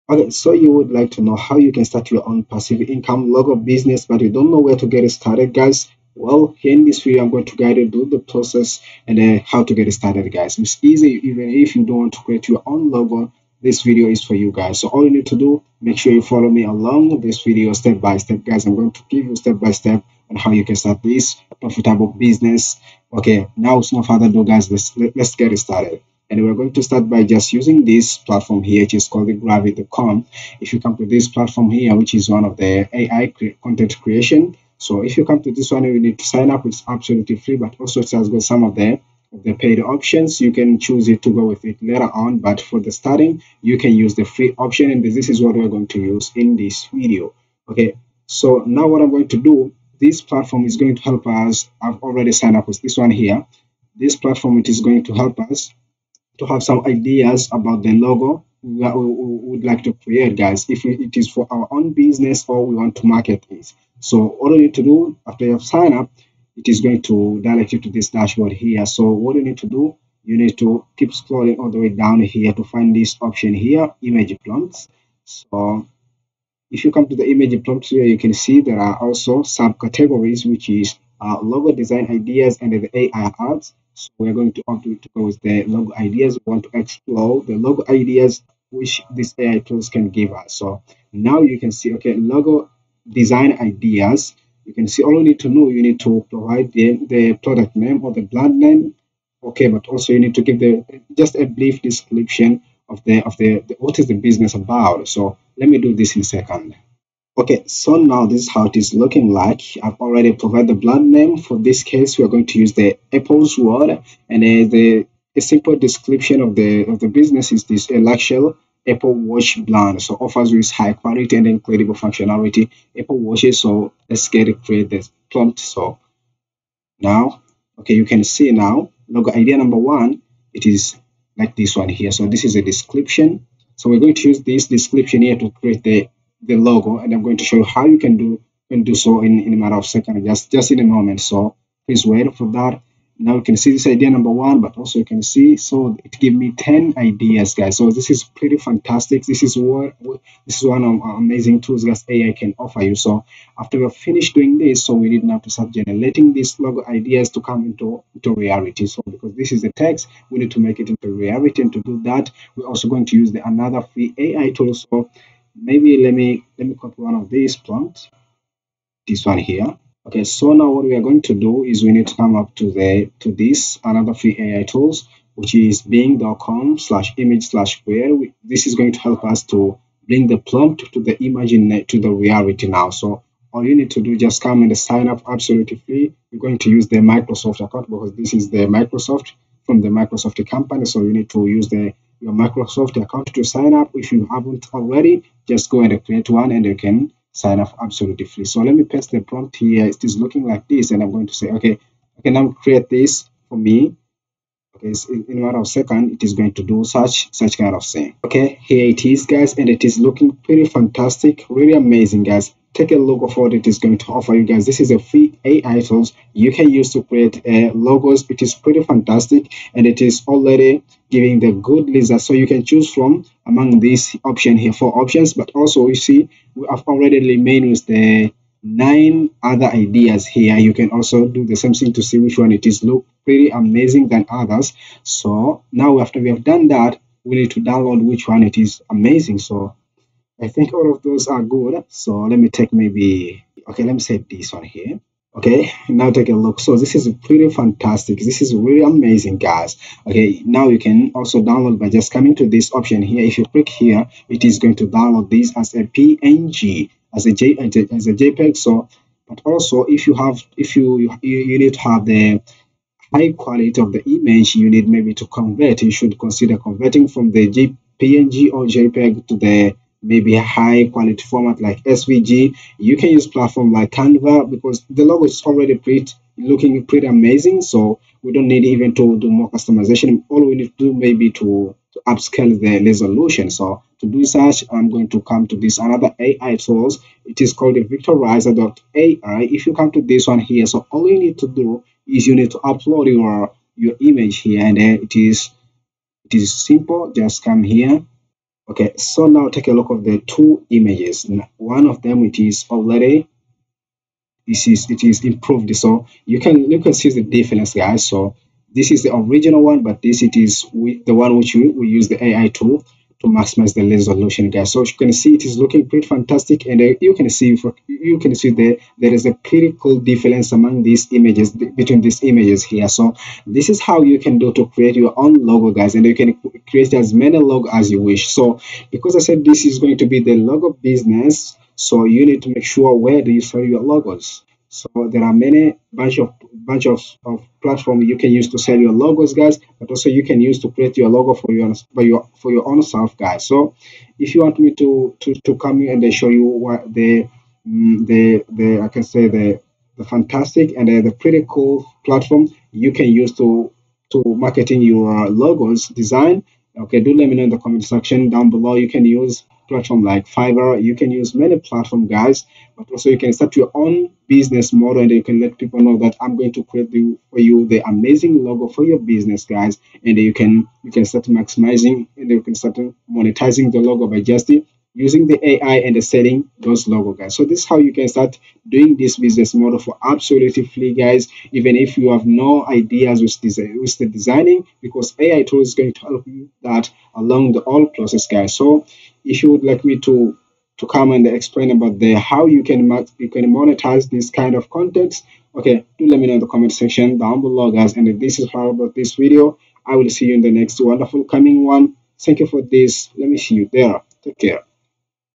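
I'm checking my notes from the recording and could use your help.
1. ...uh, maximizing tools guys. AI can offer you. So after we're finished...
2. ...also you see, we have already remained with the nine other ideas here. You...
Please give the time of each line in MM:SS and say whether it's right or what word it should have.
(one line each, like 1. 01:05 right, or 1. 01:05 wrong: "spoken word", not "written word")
1. 02:31 wrong: "amazing", not "maximizing"
2. 03:45 right.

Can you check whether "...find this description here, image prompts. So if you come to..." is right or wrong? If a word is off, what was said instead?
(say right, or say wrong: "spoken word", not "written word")
wrong: "option", not "description".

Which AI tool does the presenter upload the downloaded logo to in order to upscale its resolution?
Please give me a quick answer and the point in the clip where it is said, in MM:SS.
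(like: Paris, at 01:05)
Vectorizer.ai, at 04:47.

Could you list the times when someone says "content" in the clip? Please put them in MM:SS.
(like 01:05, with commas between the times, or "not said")
00:33, 06:34.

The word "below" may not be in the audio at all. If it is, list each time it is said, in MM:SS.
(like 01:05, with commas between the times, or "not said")
05:58, 06:37.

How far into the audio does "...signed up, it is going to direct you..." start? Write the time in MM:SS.
01:05.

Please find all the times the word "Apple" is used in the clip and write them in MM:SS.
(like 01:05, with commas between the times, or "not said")
01:53, 01:58, 02:02.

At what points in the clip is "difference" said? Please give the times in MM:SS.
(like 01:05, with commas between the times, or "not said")
05:07, 05:19.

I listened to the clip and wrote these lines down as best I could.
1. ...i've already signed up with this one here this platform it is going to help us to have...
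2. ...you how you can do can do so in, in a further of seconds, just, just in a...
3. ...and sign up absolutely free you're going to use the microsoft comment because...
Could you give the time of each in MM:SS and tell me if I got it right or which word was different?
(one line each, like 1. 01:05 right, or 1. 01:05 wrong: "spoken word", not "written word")
1. 00:51 right
2. 02:17 wrong: "matter", not "further"
3. 03:04 wrong: "account", not "comment".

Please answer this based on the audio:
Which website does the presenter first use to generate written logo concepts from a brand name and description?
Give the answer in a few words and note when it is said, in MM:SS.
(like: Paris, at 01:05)
Gravity.com, at 00:29.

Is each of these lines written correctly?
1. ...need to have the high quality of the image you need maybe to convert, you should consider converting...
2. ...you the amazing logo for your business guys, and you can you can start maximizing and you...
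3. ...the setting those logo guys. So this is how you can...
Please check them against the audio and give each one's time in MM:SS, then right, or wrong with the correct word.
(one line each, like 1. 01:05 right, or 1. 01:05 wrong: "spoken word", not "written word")
1. 04:21 right
2. 06:07 right
3. 06:15 right.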